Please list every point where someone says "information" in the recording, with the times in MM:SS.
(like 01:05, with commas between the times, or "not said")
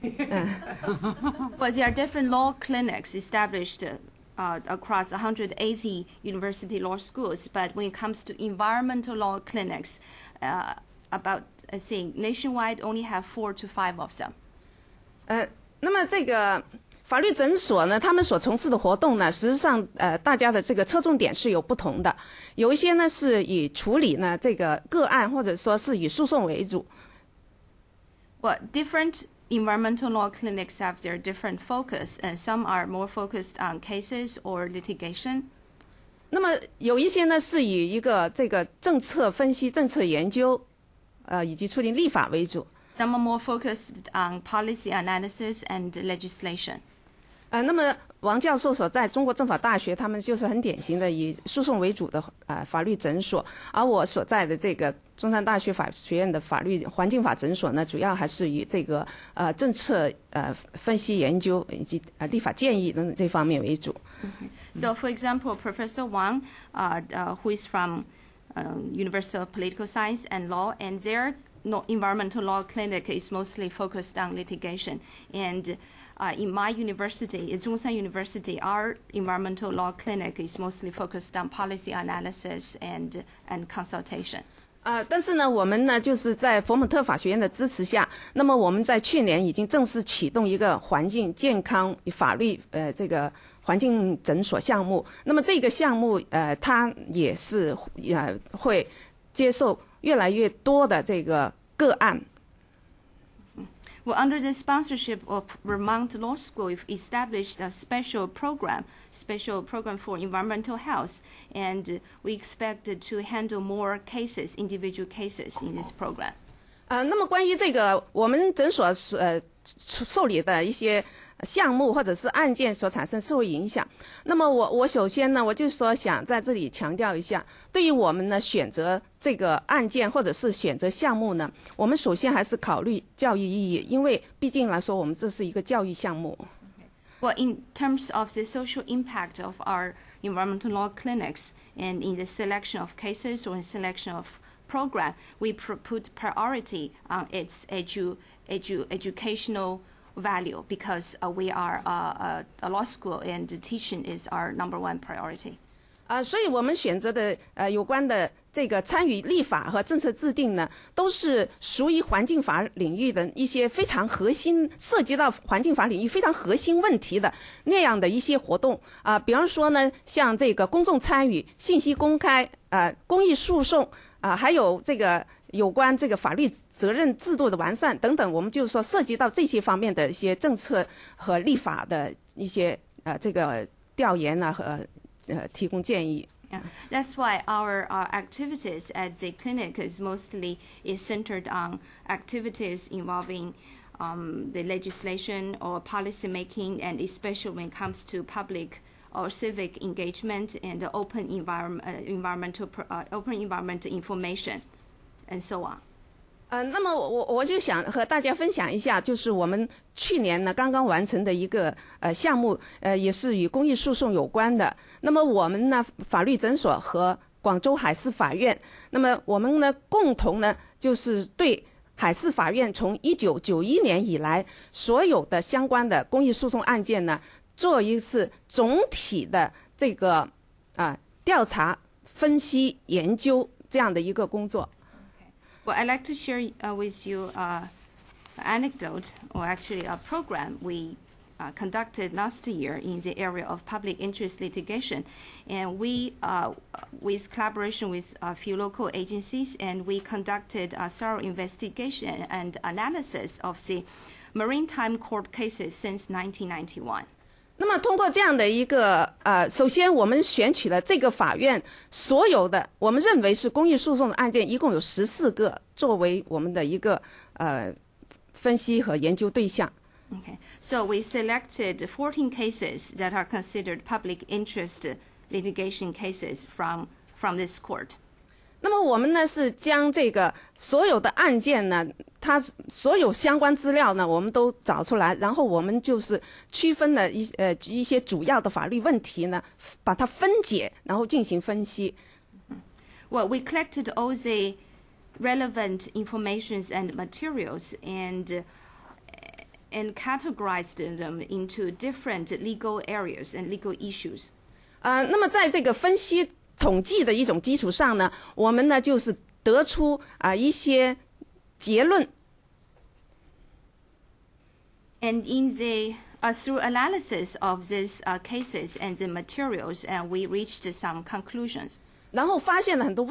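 03:23, 04:55.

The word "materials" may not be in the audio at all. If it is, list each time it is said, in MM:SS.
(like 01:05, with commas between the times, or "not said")
04:56, 05:19.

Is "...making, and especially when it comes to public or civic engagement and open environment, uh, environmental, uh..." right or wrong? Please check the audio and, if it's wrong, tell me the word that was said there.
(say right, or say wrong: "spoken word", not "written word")
right.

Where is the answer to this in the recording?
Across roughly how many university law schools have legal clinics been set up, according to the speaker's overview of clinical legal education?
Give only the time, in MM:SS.
00:05.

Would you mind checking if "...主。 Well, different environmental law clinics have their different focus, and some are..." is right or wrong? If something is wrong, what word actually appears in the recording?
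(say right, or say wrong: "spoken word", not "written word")
right.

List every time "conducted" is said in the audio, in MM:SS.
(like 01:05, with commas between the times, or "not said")
04:01, 04:09.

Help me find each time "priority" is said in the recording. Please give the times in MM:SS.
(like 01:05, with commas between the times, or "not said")
02:26, 02:35.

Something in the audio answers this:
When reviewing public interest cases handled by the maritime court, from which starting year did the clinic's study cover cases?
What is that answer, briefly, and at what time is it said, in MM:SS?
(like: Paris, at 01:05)
1991, at 04:16.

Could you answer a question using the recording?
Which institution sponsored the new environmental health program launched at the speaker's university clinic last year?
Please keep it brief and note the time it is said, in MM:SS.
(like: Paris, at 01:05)
Vermont Law School, at 01:45.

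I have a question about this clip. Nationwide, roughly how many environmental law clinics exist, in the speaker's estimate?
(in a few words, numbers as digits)
4 to 5.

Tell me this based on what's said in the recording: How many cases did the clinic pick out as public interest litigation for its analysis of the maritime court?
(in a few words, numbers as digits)
14.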